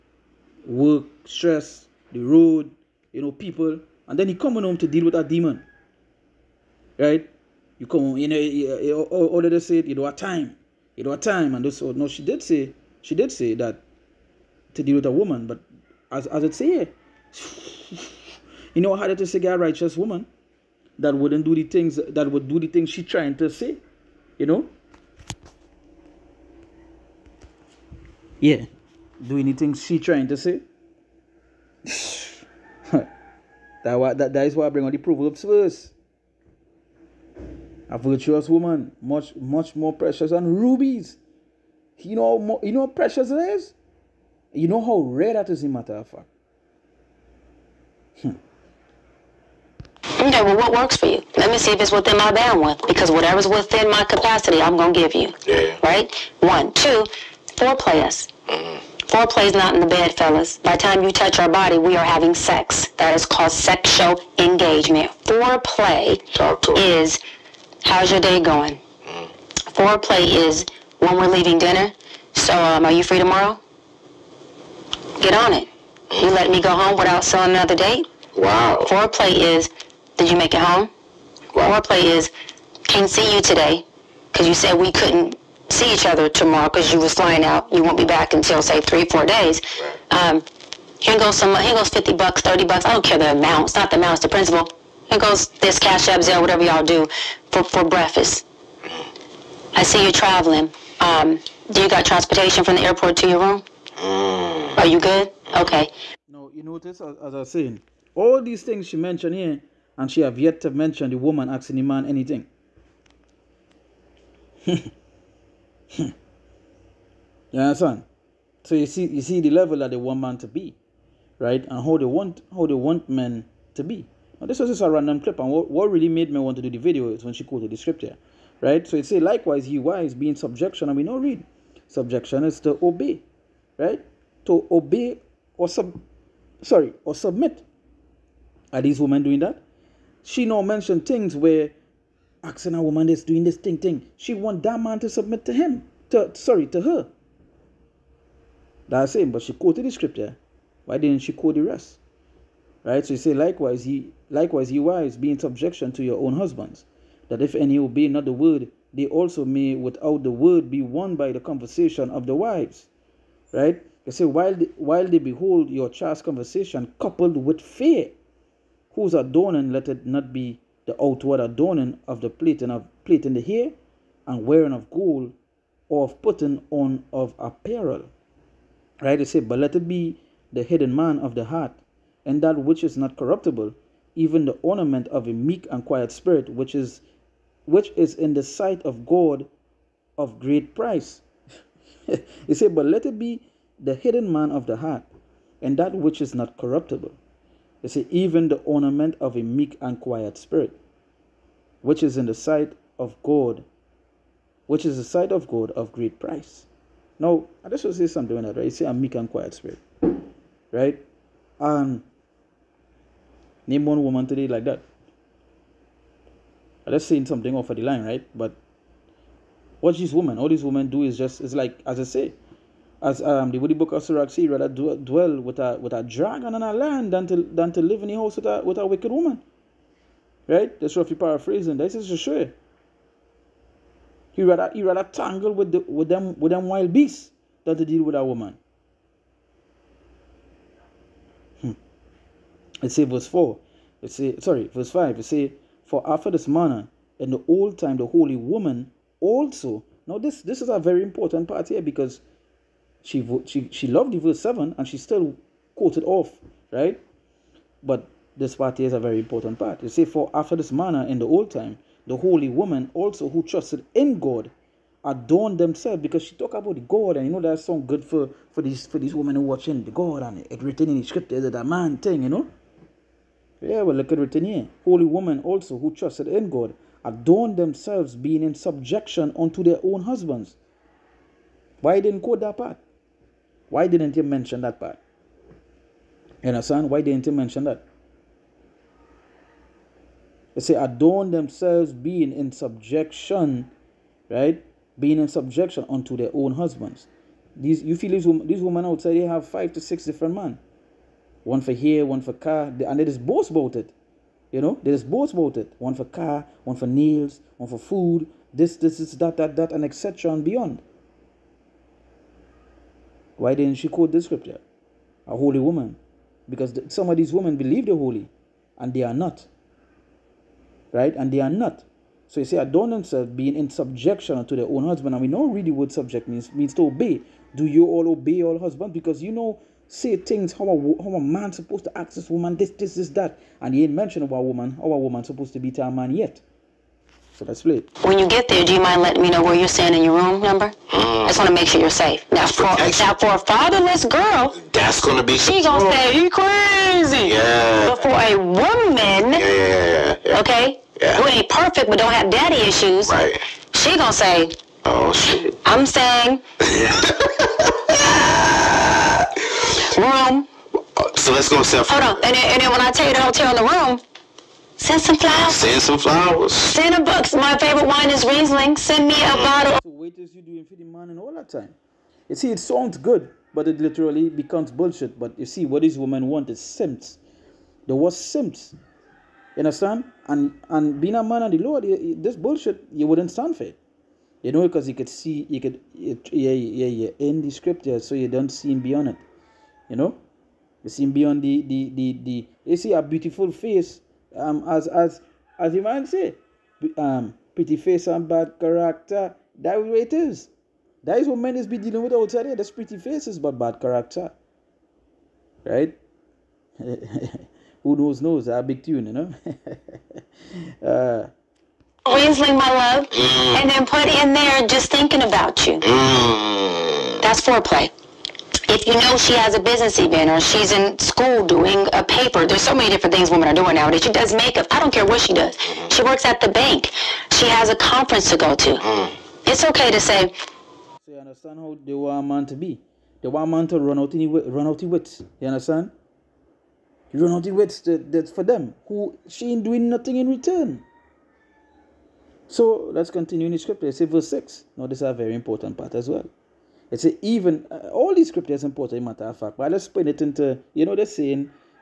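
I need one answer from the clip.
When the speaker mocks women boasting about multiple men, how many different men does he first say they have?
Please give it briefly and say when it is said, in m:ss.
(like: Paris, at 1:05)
5 to 6, at 4:59.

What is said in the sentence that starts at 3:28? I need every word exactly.
You say, I'm meek and quiet spirit, right?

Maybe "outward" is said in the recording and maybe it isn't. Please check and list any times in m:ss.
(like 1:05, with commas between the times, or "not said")
2:51.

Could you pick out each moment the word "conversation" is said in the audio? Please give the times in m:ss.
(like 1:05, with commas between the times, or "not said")
2:41, 2:46.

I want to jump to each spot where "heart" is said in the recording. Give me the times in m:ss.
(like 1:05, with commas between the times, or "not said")
3:01, 3:14.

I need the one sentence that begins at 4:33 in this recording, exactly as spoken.
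Yeah, well look at written here.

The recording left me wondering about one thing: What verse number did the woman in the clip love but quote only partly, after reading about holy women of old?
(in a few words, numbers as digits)
7.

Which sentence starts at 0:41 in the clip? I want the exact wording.
You know more, you know how precious it is?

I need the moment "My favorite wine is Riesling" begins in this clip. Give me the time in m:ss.
6:07.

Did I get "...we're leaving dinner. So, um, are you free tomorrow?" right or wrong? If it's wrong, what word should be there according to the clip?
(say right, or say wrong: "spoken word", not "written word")
right.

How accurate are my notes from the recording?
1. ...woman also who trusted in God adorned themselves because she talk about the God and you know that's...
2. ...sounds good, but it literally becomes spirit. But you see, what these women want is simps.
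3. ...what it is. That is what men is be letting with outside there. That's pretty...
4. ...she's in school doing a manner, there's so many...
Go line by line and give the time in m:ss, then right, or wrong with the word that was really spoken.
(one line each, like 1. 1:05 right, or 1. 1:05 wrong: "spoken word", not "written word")
1. 4:22 right
2. 6:12 wrong: "bullshit", not "spirit"
3. 6:39 wrong: "dealing", not "letting"
4. 7:00 wrong: "paper", not "manner".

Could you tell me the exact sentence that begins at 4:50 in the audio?
They say, adorn themselves being in subjection, right?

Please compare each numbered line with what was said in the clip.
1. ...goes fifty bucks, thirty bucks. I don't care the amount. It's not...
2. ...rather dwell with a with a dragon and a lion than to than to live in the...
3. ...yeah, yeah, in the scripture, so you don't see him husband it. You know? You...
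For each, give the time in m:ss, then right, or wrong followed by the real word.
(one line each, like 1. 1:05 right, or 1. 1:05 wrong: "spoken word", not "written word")
1. 1:31 right
2. 3:44 right
3. 6:26 wrong: "beyond", not "husband".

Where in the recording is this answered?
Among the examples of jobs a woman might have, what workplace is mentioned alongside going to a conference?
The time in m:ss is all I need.
7:06.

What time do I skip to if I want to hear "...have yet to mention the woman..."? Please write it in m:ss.
1:50.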